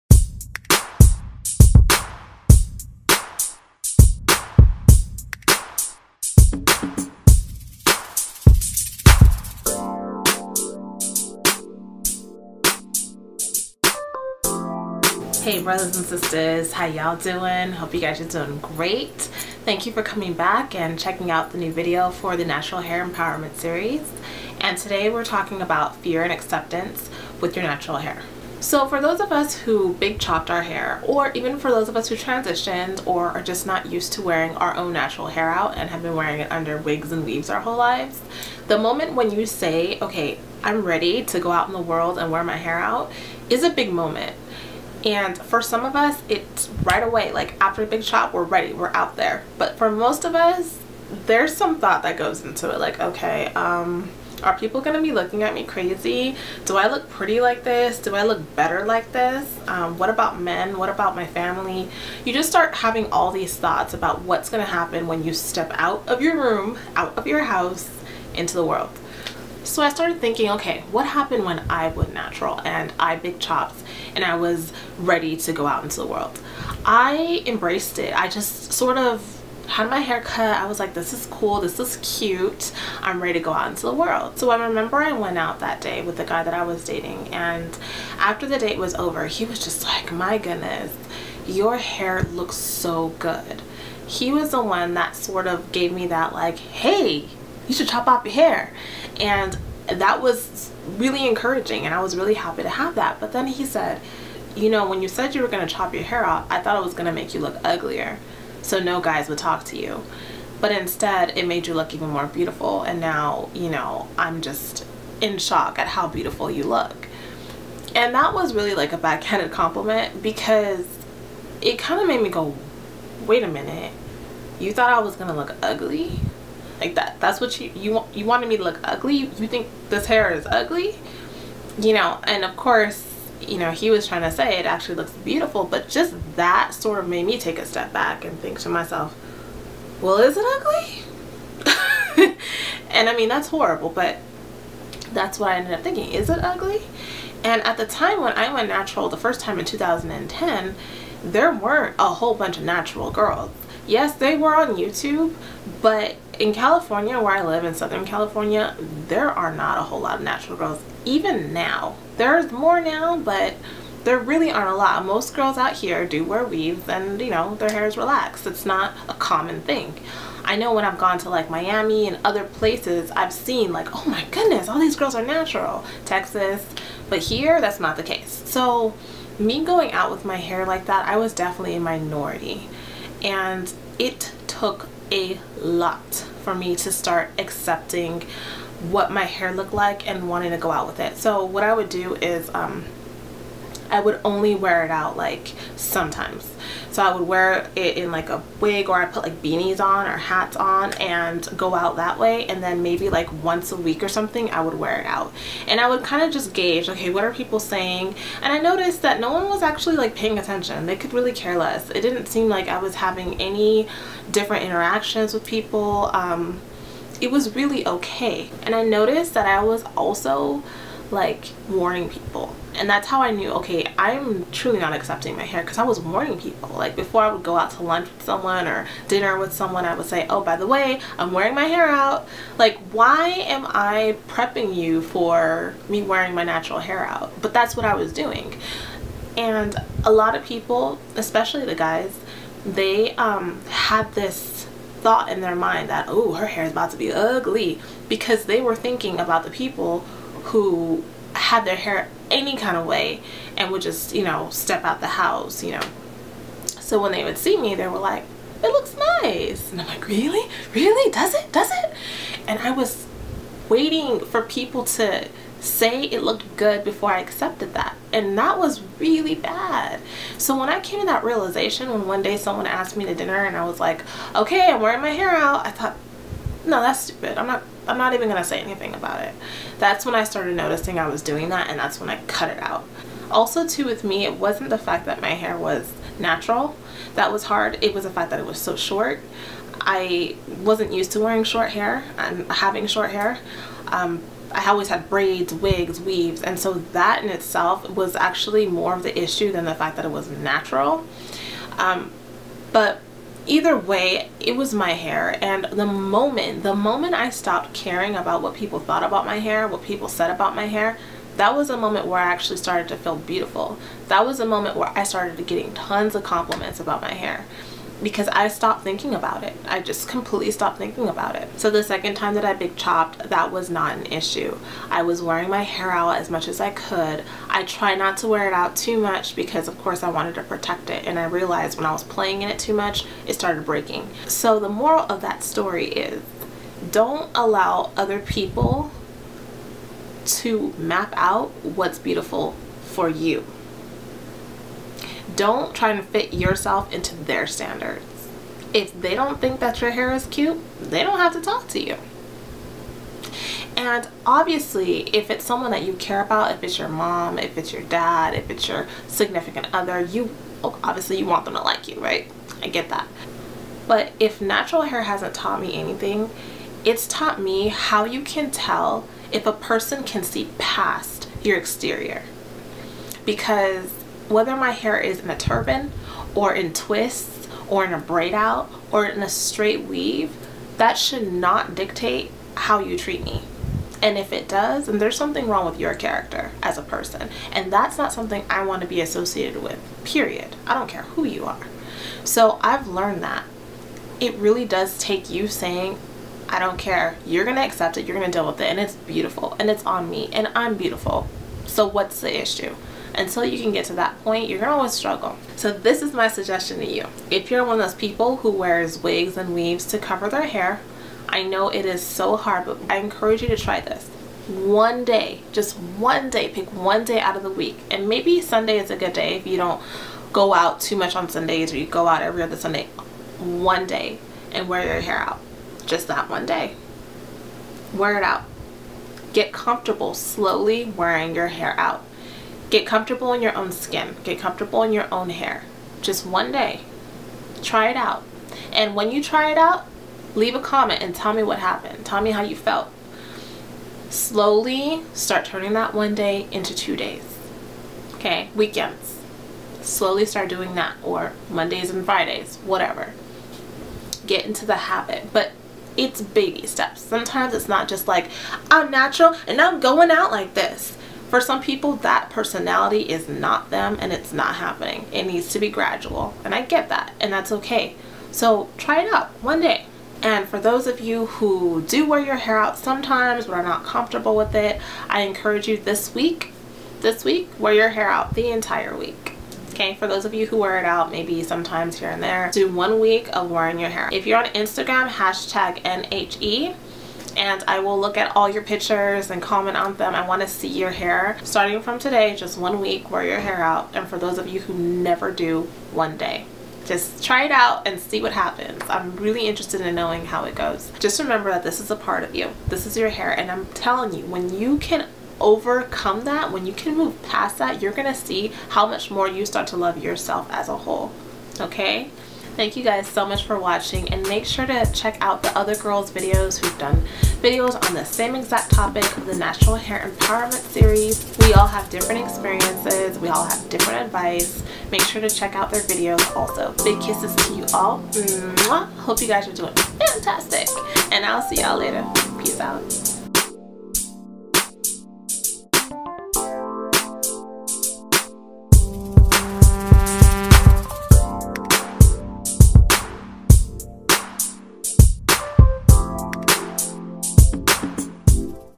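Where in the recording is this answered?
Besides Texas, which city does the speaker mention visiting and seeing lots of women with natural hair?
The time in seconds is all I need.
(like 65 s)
171 s.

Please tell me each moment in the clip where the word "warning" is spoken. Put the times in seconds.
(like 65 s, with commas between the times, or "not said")
221 s, 225 s.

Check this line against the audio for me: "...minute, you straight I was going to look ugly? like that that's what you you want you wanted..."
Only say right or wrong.
wrong.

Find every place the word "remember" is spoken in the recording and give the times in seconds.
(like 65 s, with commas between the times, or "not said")
84 s, 501 s.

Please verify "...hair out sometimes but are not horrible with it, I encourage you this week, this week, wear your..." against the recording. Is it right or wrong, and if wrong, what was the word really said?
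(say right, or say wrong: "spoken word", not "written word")
wrong: "comfortable", not "horrible".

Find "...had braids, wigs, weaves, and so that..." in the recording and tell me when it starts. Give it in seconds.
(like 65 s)
294 s.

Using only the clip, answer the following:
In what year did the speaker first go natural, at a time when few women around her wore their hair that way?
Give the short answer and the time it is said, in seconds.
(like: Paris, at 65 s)
2010, at 149 s.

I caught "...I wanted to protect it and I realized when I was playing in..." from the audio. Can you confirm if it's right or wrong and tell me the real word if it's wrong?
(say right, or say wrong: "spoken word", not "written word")
right.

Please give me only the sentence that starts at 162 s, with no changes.
There's more now, but there really aren't a lot.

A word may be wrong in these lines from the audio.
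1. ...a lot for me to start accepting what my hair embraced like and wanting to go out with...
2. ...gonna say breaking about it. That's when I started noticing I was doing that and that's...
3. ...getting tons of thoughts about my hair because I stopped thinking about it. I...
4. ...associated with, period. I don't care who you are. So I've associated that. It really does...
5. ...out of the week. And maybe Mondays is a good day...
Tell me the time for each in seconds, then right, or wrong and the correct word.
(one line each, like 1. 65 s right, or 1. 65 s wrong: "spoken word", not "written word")
1. 185 s wrong: "looked", not "embraced"
2. 278 s wrong: "anything", not "breaking"
3. 315 s wrong: "compliments", not "thoughts"
4. 389 s wrong: "learned", not "associated"
5. 417 s wrong: "Sunday", not "Mondays".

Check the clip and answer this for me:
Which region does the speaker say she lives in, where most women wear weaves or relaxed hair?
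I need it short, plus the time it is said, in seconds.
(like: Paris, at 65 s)
Southern California, at 157 s.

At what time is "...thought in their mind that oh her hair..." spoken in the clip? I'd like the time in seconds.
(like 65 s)
245 s.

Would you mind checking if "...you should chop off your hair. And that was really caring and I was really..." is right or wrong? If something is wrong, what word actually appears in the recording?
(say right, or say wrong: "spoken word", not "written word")
wrong: "encouraging", not "caring".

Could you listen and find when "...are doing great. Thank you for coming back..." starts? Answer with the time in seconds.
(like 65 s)
18 s.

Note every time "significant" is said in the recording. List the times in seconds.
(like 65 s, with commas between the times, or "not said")
359 s.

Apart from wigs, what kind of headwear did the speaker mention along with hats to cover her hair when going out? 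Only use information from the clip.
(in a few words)
beanies.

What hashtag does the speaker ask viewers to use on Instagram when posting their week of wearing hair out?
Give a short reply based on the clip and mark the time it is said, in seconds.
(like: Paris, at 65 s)
NHE, at 485 s.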